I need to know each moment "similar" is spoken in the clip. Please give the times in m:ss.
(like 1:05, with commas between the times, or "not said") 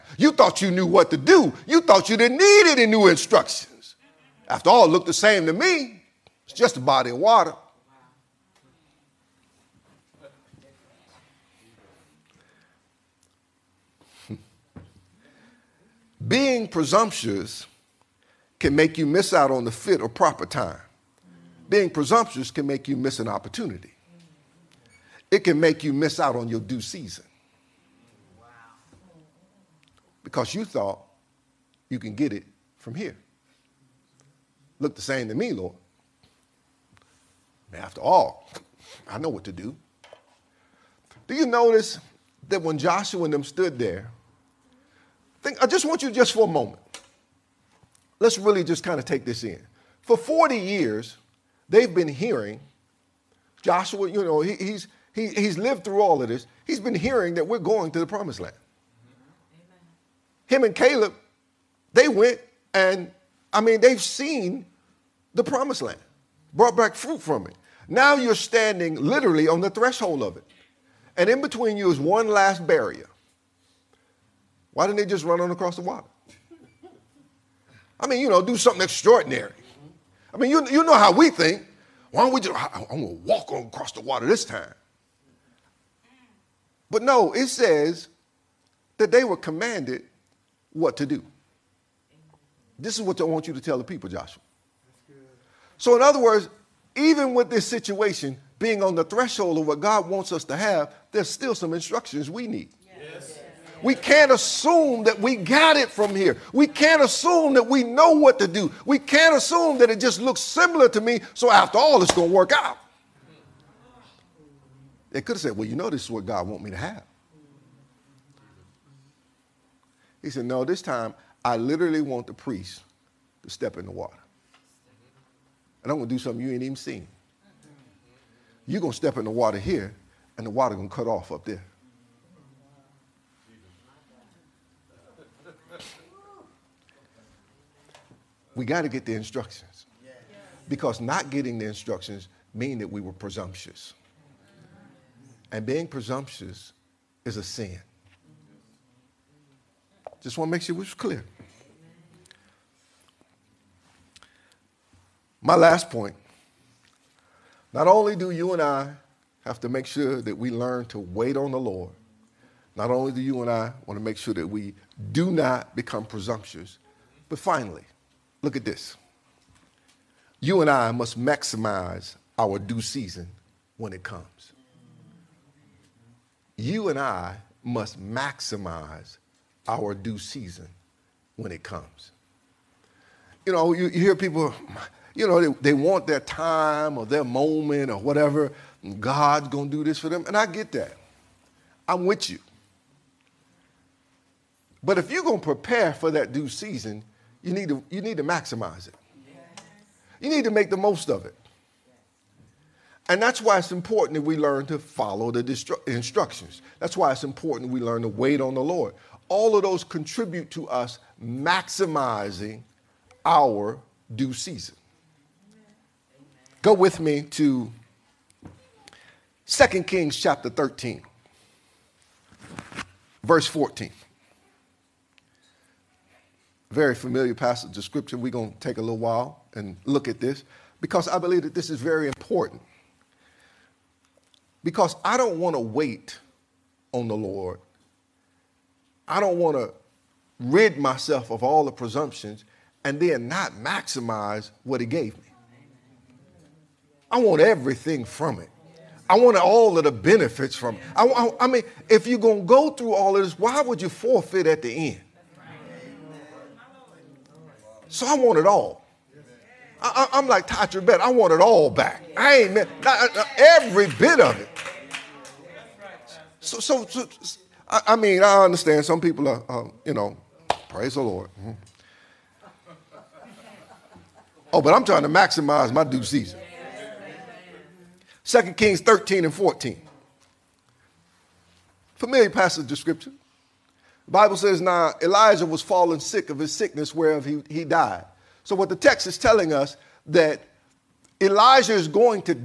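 1:50.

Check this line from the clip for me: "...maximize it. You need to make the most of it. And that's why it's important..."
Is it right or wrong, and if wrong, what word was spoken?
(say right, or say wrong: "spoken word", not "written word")
right.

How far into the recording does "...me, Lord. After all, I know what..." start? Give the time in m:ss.
0:35.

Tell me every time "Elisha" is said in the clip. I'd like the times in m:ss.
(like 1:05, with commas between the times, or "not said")
4:45, 4:51.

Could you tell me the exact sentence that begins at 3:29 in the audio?
All of those contribute to us maximizing our due season.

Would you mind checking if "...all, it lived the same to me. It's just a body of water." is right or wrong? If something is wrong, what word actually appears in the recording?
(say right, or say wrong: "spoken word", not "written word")
wrong: "looked", not "lived".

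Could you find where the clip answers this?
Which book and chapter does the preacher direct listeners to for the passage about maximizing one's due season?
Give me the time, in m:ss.
3:39.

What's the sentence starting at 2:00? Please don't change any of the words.
He said, No, this time I literally want the priest to step in the water.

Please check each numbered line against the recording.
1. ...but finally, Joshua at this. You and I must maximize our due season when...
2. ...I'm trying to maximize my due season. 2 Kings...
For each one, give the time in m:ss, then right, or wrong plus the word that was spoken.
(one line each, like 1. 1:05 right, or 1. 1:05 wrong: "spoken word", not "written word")
1. 2:47 wrong: "Look", not "Joshua"
2. 4:34 right.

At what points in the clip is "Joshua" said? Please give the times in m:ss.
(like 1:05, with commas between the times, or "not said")
0:42, 0:53, 1:34.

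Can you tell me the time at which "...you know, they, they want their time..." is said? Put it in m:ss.
3:05.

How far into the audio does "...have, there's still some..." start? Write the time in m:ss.
1:40.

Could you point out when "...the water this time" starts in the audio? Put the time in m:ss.
1:23.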